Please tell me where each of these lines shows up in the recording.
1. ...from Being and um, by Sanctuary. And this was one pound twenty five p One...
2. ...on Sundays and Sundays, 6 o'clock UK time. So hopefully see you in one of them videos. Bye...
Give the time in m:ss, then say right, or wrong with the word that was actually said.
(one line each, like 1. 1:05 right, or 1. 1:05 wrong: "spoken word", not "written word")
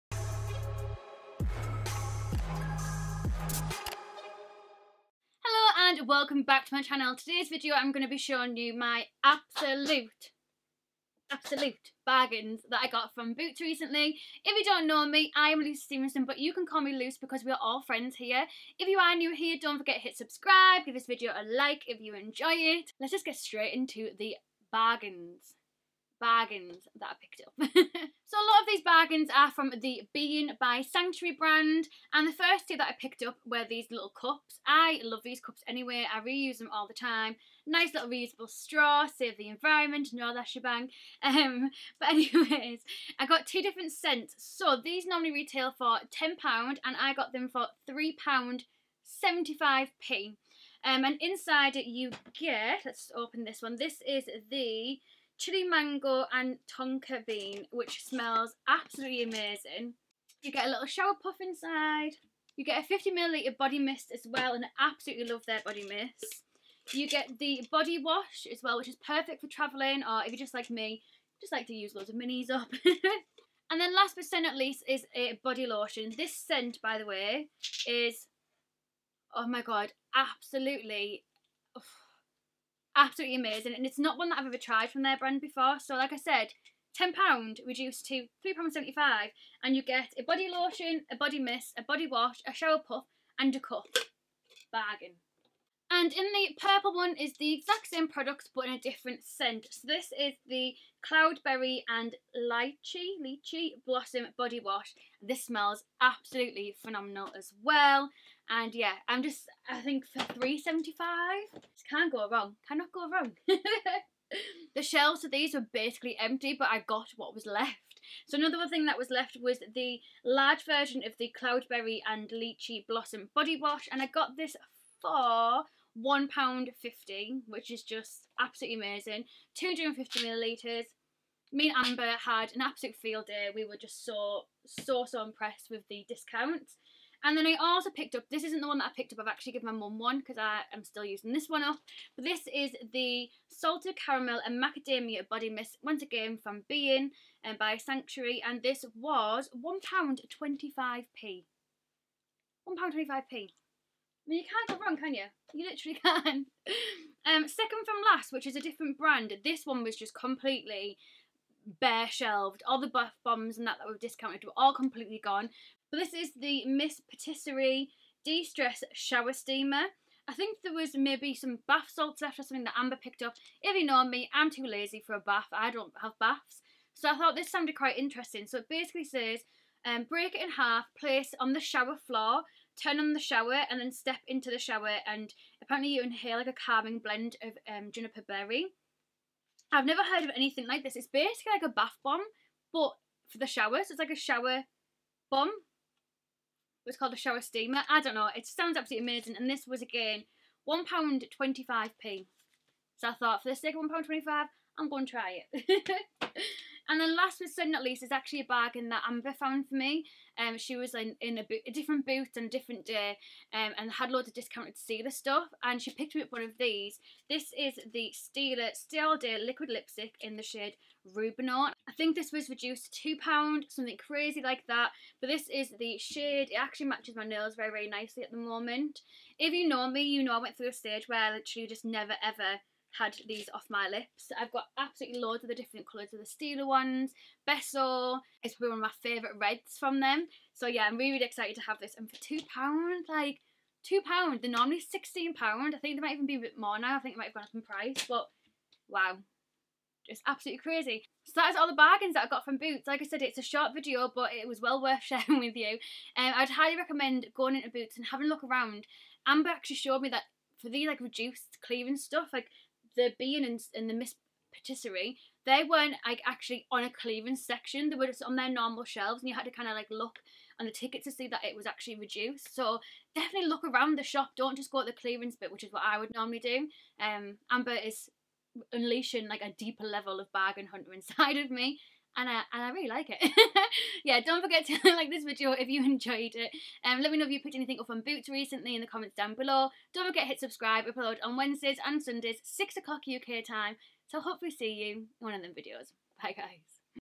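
1. 2:26 right
2. 4:51 wrong: "Wednesdays", not "Sundays".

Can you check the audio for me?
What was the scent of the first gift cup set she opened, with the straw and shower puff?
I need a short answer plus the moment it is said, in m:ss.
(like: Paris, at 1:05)
Chili mango and tonka bean, at 0:55.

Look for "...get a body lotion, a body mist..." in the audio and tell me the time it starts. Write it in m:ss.
1:29.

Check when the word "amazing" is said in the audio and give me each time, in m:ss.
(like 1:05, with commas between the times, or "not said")
0:59, 1:23, 2:08, 3:19.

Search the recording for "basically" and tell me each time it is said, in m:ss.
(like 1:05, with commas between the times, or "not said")
1:55, 2:58, 3:11.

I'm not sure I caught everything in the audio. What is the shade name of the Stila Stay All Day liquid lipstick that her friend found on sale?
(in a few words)
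Rubinaut.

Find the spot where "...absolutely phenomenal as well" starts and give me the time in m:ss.
1:45.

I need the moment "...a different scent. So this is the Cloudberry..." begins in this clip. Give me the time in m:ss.
1:38.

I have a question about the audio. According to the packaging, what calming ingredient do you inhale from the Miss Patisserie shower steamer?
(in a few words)
Juniper berry.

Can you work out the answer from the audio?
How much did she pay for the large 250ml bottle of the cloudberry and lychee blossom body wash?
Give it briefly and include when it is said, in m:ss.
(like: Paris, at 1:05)
£1.50, at 2:05.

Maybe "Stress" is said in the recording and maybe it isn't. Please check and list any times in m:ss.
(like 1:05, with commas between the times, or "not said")
2:48.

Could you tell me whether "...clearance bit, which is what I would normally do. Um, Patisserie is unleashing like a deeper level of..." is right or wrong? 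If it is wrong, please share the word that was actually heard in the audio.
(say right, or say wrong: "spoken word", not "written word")
wrong: "Amber", not "Patisserie".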